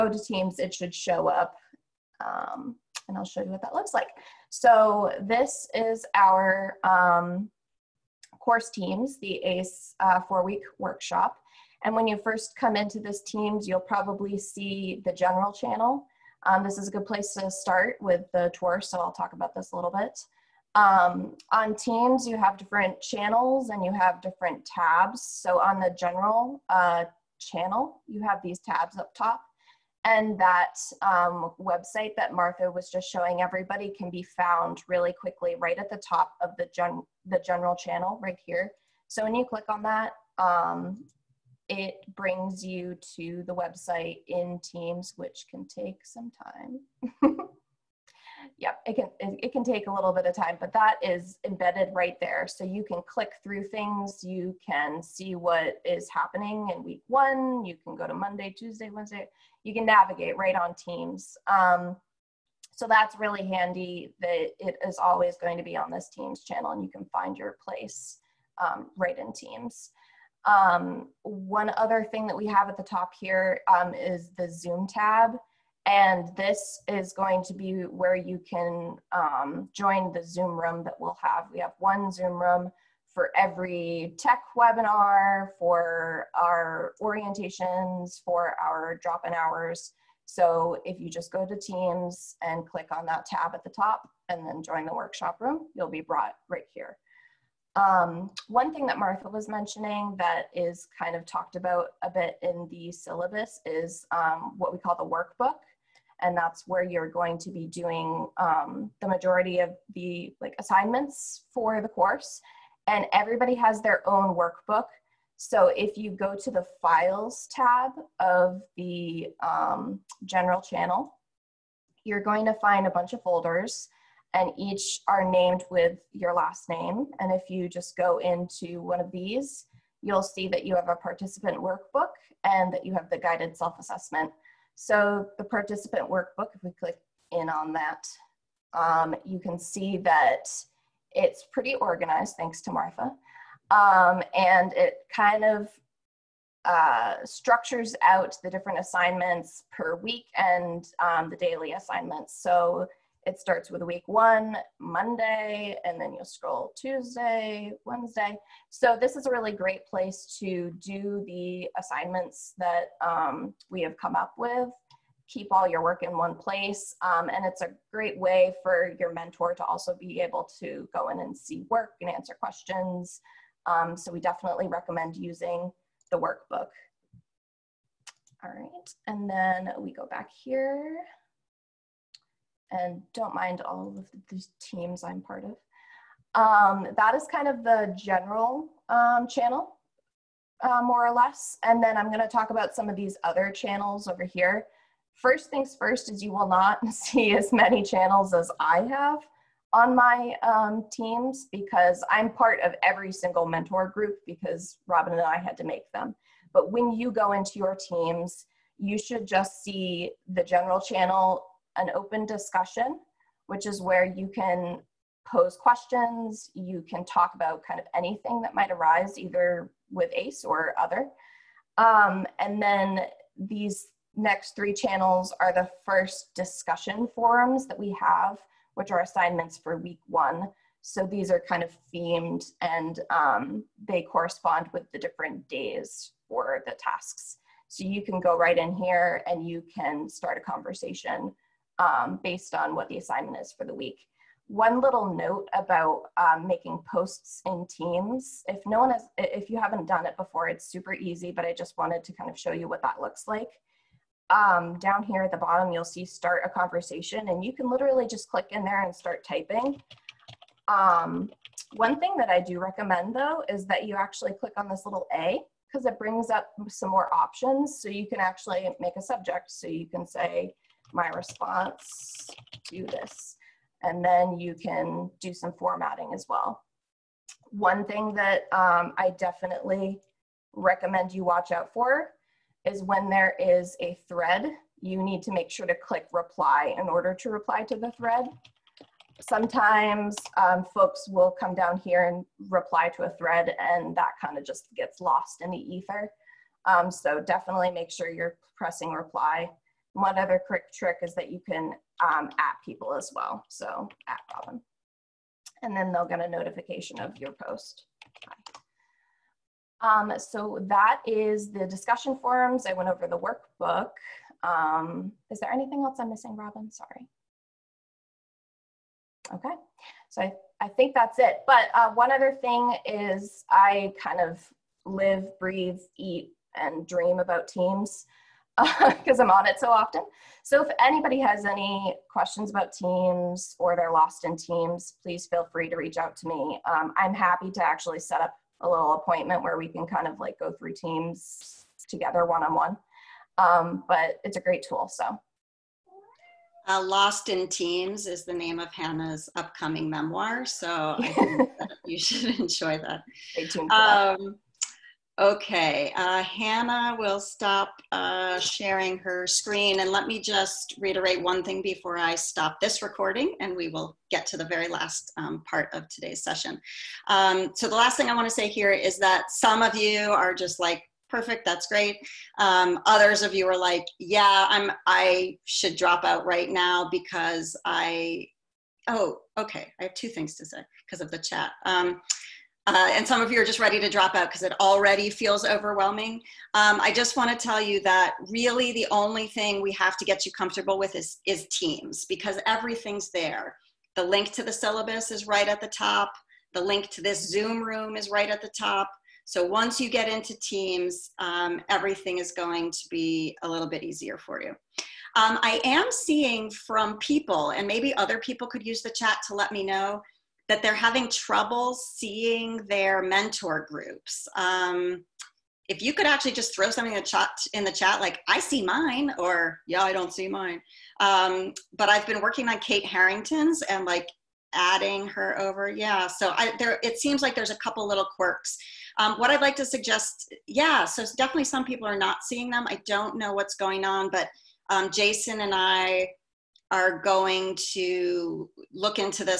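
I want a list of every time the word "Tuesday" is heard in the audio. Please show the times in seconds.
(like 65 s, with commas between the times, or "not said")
58 s, 156 s.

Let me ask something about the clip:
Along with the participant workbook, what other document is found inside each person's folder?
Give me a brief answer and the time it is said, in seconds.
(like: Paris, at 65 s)
Guided self-assessment, at 133 s.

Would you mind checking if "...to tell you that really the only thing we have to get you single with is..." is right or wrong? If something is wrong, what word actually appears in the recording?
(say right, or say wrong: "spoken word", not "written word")
wrong: "comfortable", not "single".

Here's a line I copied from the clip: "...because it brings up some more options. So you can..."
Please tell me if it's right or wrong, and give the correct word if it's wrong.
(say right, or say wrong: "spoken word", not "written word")
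right.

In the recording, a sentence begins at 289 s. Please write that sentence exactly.
Sometimes um, folks will come down here and reply to a thread and that kind of just gets lost in the ether.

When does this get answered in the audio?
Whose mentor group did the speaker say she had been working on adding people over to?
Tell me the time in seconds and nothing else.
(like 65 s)
422 s.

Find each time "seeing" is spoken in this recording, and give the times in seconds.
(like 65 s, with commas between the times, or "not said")
405 s, 411 s, 432 s.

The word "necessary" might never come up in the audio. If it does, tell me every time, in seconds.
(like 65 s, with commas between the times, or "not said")
not said.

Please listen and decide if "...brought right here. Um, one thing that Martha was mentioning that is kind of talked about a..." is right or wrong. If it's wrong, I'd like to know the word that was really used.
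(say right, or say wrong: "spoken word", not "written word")
right.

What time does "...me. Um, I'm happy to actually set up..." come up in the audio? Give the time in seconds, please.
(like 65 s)
336 s.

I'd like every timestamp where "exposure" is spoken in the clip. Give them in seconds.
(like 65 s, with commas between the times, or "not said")
not said.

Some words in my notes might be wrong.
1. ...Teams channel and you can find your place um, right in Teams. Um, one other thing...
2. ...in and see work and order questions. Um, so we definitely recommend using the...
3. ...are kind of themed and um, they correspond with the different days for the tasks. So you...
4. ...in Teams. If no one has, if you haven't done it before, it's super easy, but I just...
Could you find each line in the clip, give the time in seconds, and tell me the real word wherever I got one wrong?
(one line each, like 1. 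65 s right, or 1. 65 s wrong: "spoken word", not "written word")
1. 66 s right
2. 171 s wrong: "answer", not "order"
3. 231 s right
4. 247 s right.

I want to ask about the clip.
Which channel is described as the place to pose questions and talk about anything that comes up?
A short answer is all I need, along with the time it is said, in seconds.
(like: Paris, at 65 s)
Open discussion, at 211 s.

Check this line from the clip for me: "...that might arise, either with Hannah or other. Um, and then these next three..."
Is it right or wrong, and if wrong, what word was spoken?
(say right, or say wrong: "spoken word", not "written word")
wrong: "ACE", not "Hannah".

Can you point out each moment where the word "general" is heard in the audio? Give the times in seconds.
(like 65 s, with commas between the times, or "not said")
15 s, 25 s, 37 s, 120 s, 187 s, 210 s.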